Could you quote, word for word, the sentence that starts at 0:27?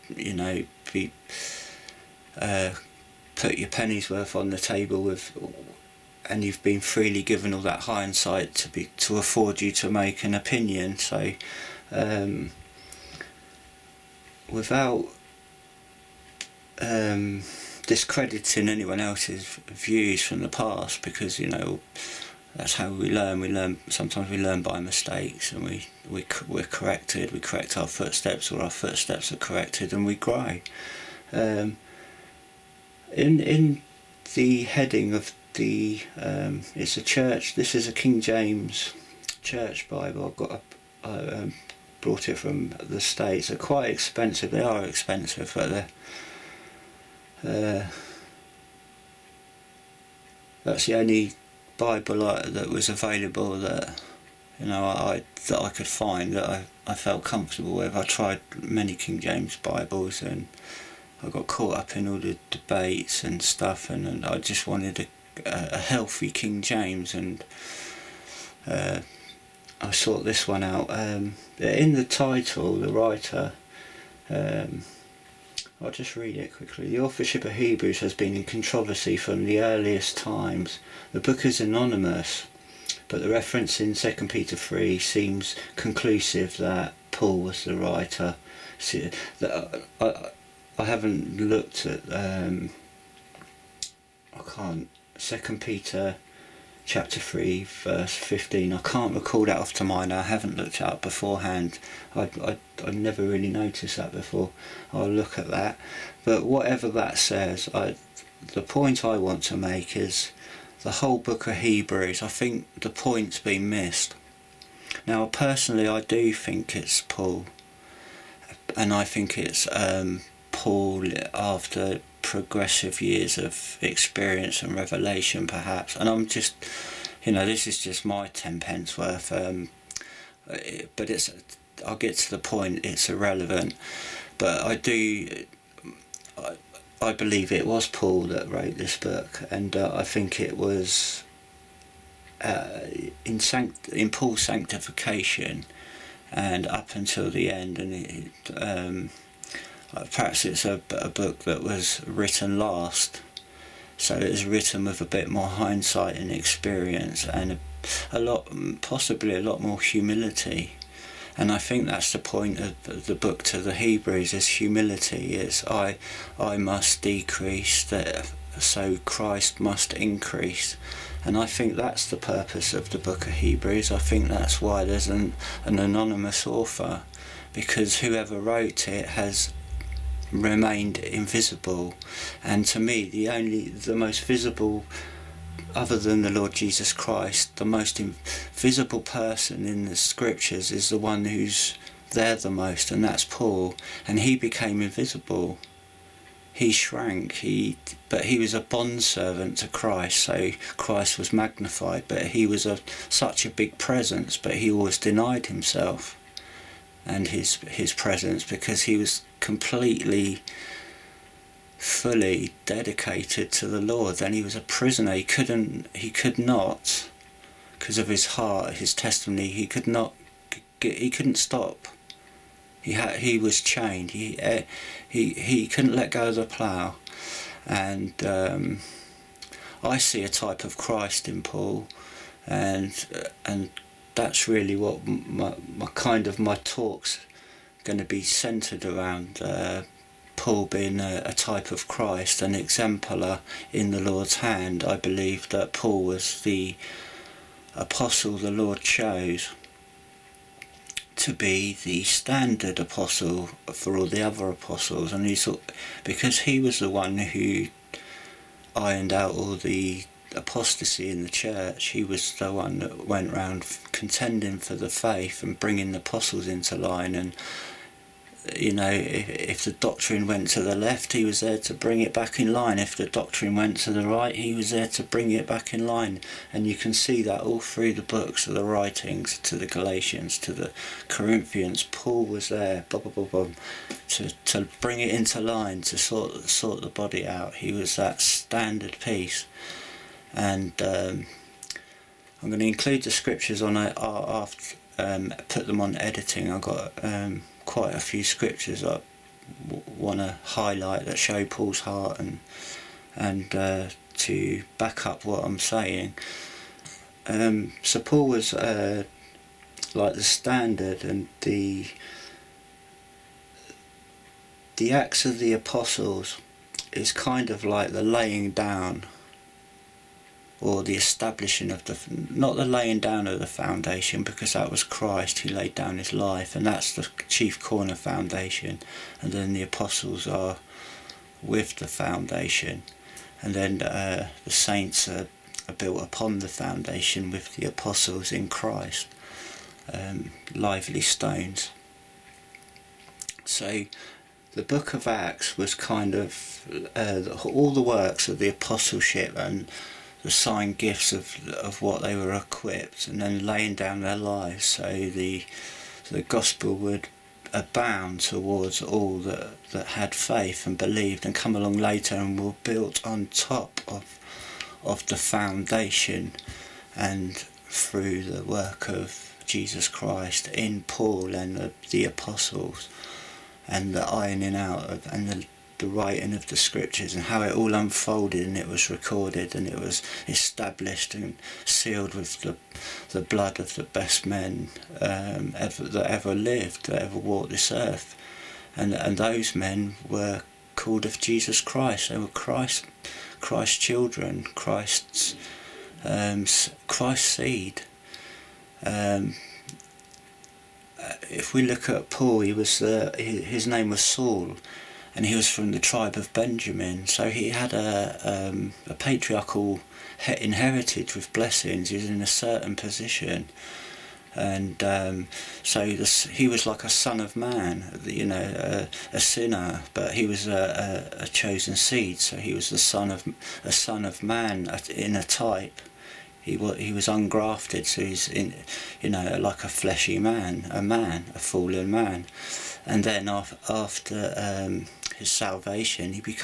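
We correct our footsteps, or our footsteps are corrected, and we grow.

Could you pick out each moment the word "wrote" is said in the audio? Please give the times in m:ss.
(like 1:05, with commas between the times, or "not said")
2:18, 2:58.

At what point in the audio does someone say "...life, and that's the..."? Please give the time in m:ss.
5:26.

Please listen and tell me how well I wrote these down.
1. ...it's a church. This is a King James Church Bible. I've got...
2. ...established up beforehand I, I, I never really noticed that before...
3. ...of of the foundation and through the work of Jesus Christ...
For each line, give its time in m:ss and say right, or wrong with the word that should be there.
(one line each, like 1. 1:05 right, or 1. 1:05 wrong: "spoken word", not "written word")
1. 0:36 right
2. 1:40 wrong: "looked", not "established"
3. 6:03 right.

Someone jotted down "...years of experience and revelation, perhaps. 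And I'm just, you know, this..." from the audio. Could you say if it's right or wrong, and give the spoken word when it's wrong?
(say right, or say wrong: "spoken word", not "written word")
right.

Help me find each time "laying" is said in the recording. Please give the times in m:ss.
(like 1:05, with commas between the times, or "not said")
5:18, 5:22, 5:53.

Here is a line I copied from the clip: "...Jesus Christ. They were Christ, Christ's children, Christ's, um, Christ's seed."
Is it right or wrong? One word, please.
right.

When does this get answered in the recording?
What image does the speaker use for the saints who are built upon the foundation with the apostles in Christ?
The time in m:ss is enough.
5:40.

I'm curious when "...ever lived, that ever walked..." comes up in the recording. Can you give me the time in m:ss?
6:26.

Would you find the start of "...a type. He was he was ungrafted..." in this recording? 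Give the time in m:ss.
7:05.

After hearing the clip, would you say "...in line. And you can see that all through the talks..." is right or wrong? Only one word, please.
wrong.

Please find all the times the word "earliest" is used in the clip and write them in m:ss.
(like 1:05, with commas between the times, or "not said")
1:19.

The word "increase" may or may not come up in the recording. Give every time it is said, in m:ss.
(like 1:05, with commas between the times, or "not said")
2:49.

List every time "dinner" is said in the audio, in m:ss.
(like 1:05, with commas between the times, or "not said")
not said.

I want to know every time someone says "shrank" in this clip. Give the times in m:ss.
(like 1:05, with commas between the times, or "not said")
3:16.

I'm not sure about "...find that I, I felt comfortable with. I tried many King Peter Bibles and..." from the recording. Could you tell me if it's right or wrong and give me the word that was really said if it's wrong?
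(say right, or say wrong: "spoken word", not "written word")
wrong: "James", not "Peter".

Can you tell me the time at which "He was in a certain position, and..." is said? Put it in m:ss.
6:51.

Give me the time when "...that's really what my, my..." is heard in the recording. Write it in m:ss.
3:54.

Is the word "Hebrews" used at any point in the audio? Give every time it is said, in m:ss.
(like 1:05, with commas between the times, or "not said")
1:17, 1:51, 2:43, 2:53.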